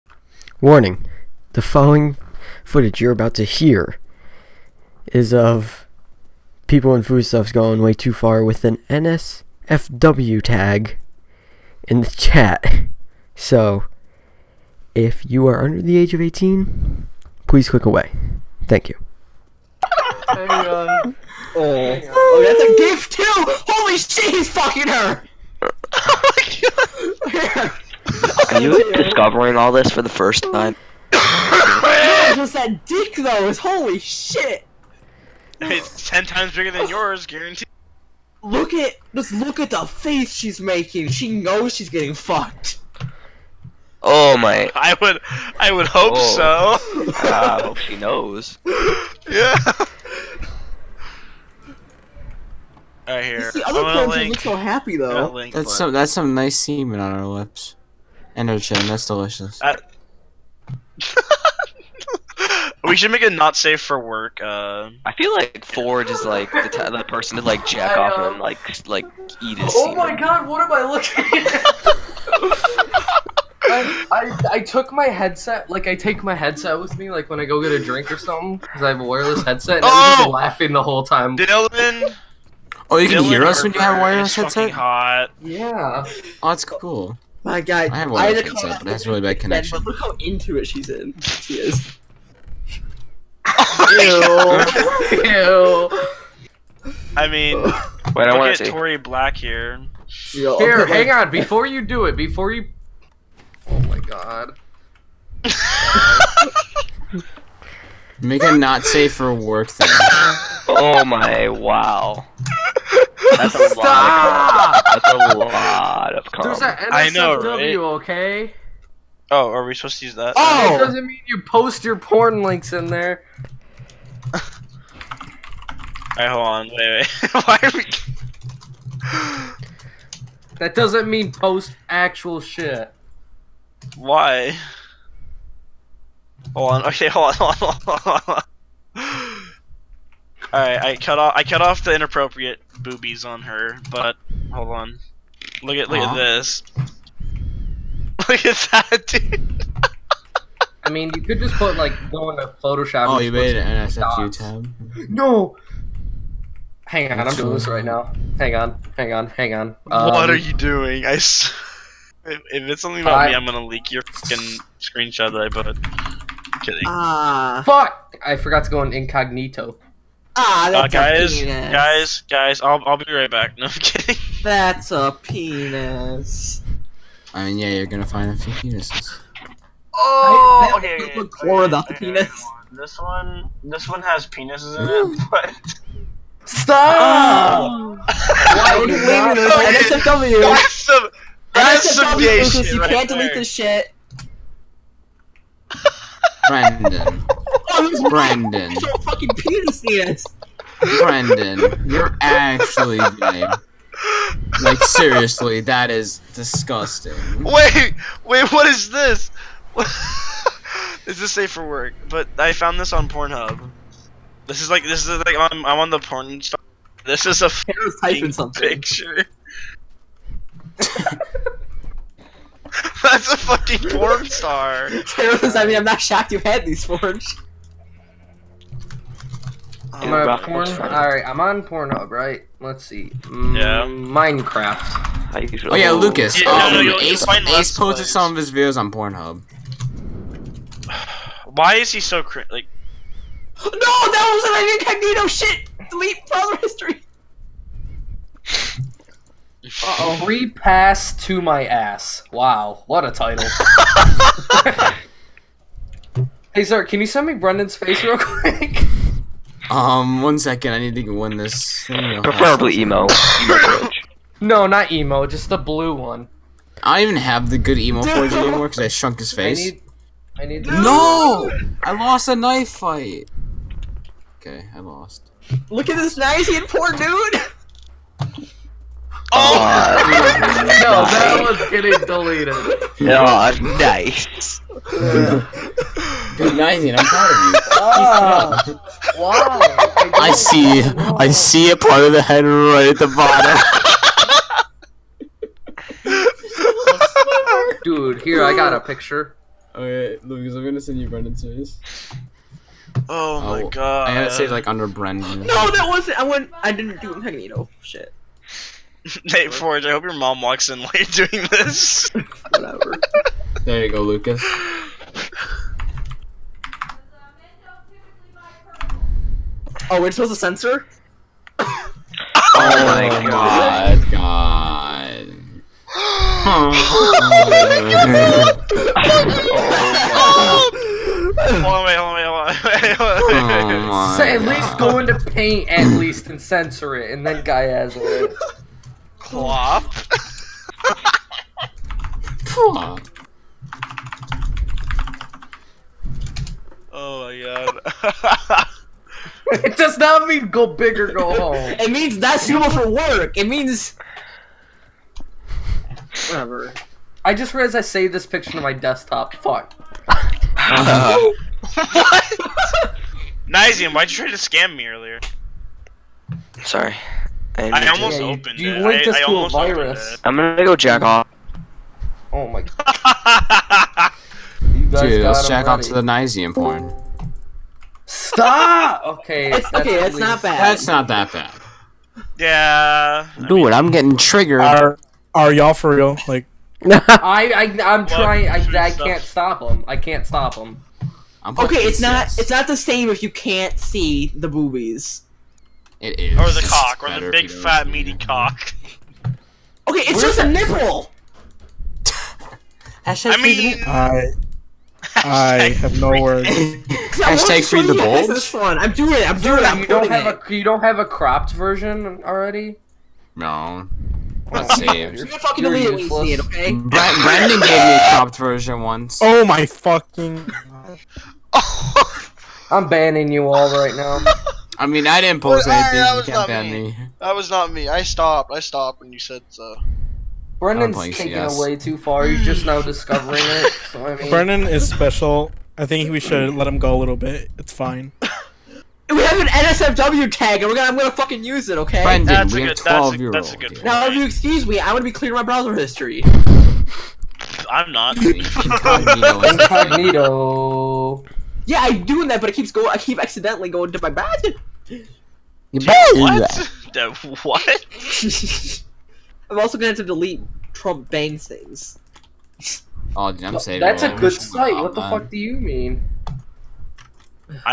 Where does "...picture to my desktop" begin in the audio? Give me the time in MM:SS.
05:58.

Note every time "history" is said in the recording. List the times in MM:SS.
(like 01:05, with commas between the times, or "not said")
04:06, 07:25.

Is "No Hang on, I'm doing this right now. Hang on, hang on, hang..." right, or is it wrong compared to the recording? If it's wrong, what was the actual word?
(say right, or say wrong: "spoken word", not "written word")
right.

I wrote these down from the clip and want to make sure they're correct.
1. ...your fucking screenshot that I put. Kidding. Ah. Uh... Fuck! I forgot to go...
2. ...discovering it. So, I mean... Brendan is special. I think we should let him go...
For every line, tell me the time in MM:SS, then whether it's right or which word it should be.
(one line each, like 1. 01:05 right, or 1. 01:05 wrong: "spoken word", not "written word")
1. 02:43 right
2. 07:12 right.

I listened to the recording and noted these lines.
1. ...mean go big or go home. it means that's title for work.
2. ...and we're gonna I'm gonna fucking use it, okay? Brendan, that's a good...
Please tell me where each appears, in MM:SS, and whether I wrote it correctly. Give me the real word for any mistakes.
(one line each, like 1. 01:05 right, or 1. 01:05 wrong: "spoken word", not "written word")
1. 05:50 wrong: "suitable", not "title"
2. 07:20 right.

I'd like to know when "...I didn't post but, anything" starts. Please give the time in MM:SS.
07:05.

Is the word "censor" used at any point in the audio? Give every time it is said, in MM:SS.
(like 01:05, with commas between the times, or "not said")
05:20, 05:36.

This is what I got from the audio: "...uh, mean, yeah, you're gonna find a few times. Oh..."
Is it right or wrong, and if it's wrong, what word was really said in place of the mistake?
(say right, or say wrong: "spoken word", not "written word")
wrong: "penises", not "times".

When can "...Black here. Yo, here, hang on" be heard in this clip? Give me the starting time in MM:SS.
01:38.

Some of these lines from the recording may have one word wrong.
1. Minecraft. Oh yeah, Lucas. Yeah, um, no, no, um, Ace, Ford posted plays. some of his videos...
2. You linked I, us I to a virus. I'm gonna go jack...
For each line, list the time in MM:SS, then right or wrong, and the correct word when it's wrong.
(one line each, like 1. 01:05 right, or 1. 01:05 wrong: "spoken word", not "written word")
1. 03:53 wrong: "Ace", not "Ford"
2. 06:08 right.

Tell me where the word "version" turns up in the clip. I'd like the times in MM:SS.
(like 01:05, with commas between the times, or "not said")
06:51, 06:58.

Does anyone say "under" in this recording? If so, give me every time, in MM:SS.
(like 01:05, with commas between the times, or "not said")
00:15, 05:04.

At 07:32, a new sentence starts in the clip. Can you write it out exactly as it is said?
I keep accidentally going to my bad.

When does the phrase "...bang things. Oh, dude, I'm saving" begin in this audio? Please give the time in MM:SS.
07:41.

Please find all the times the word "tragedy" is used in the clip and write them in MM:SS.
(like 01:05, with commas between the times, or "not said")
not said.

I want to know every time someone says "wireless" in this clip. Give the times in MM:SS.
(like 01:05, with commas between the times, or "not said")
01:19, 01:24.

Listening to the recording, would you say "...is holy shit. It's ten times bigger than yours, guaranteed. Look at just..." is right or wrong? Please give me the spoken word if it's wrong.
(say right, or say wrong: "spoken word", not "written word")
right.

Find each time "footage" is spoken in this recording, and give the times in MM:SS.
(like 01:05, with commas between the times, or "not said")
00:02.